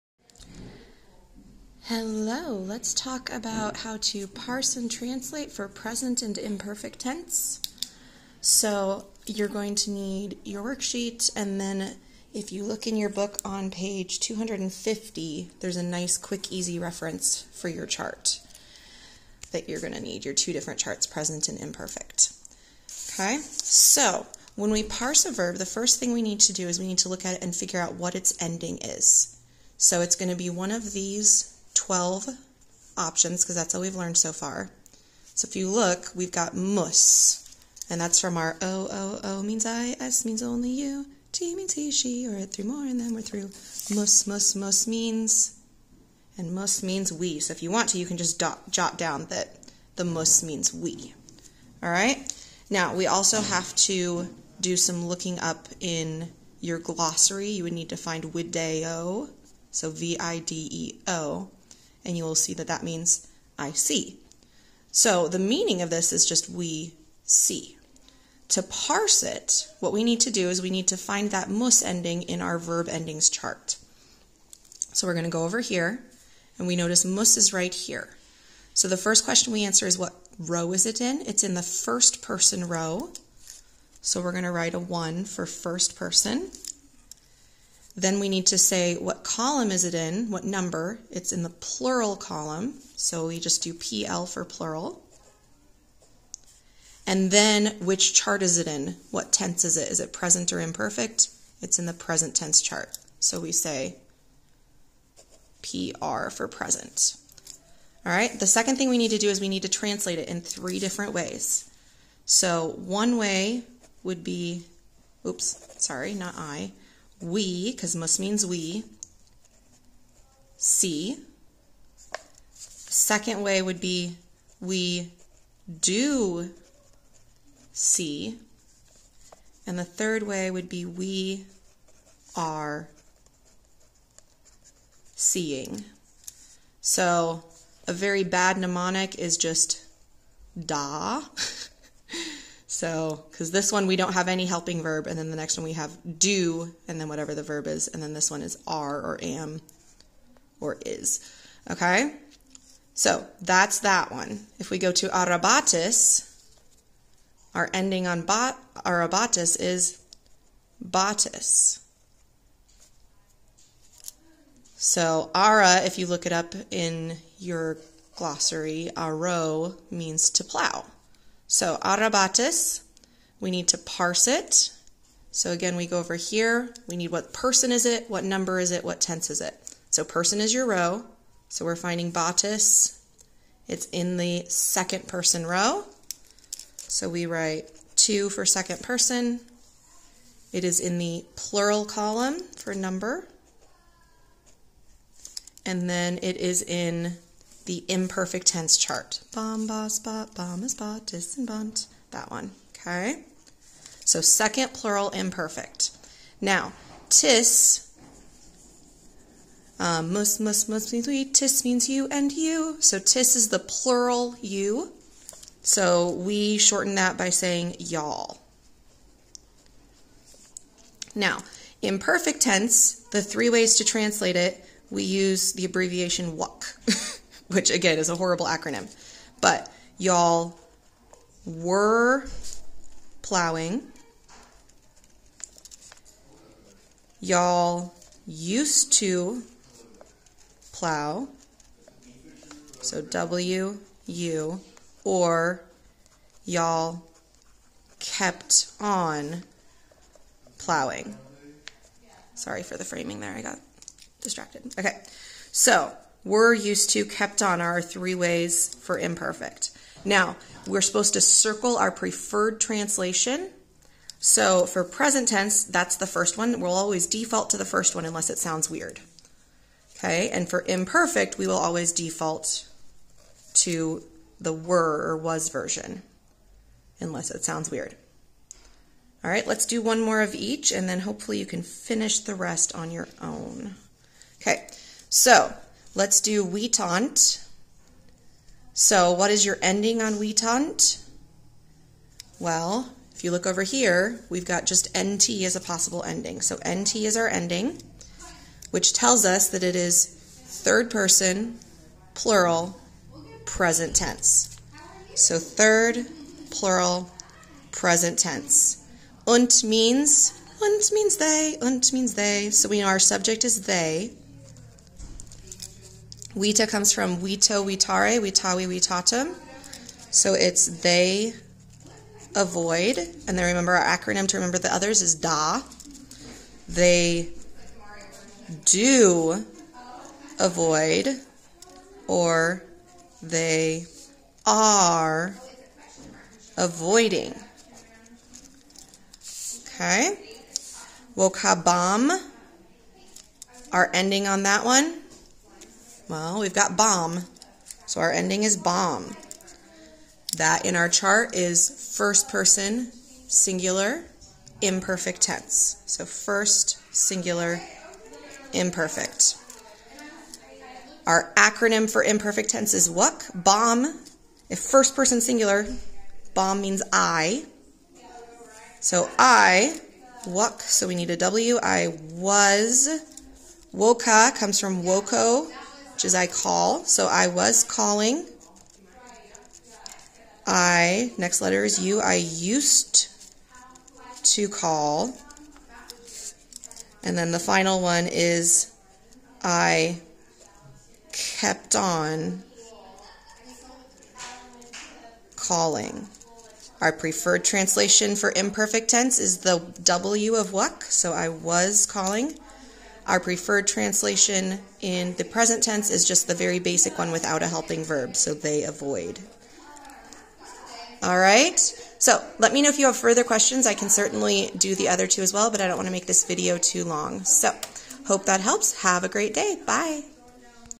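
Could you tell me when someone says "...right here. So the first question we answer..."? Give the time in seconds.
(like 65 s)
77 s.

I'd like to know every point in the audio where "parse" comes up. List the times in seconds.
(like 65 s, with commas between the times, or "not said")
4 s, 24 s, 68 s, 173 s.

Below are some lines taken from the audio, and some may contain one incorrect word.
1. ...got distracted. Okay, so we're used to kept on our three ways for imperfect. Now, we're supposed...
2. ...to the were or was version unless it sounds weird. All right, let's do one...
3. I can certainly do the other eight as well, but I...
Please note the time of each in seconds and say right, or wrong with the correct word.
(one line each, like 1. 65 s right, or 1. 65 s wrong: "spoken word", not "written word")
1. 253 s right
2. 273 s right
3. 413 s wrong: "two", not "eight".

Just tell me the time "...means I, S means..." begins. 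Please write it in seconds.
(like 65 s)
39 s.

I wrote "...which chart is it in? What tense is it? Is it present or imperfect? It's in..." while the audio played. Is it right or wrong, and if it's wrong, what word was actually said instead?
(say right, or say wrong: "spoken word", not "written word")
right.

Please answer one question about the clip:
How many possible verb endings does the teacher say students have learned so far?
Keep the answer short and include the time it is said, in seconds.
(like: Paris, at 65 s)
12, at 31 s.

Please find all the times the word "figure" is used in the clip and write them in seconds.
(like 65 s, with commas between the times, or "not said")
27 s.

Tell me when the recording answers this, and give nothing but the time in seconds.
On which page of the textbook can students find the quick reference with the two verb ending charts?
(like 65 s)
14 s.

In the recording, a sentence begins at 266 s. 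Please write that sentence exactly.
We'll always default to the first one unless it sounds weird.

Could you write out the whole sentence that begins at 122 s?
Second way would be we do see.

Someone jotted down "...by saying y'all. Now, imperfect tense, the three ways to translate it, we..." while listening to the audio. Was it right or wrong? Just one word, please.
right.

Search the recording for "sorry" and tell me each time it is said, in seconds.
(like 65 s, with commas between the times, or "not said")
115 s, 252 s.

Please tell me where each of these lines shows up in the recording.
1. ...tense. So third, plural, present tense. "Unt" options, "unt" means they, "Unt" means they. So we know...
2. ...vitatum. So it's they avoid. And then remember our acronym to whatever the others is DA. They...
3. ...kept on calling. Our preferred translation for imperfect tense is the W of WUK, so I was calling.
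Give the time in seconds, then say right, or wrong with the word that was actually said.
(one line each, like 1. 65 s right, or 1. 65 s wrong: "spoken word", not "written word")
1. 303 s wrong: "means", not "options"
2. 318 s wrong: "remember", not "whatever"
3. 391 s right.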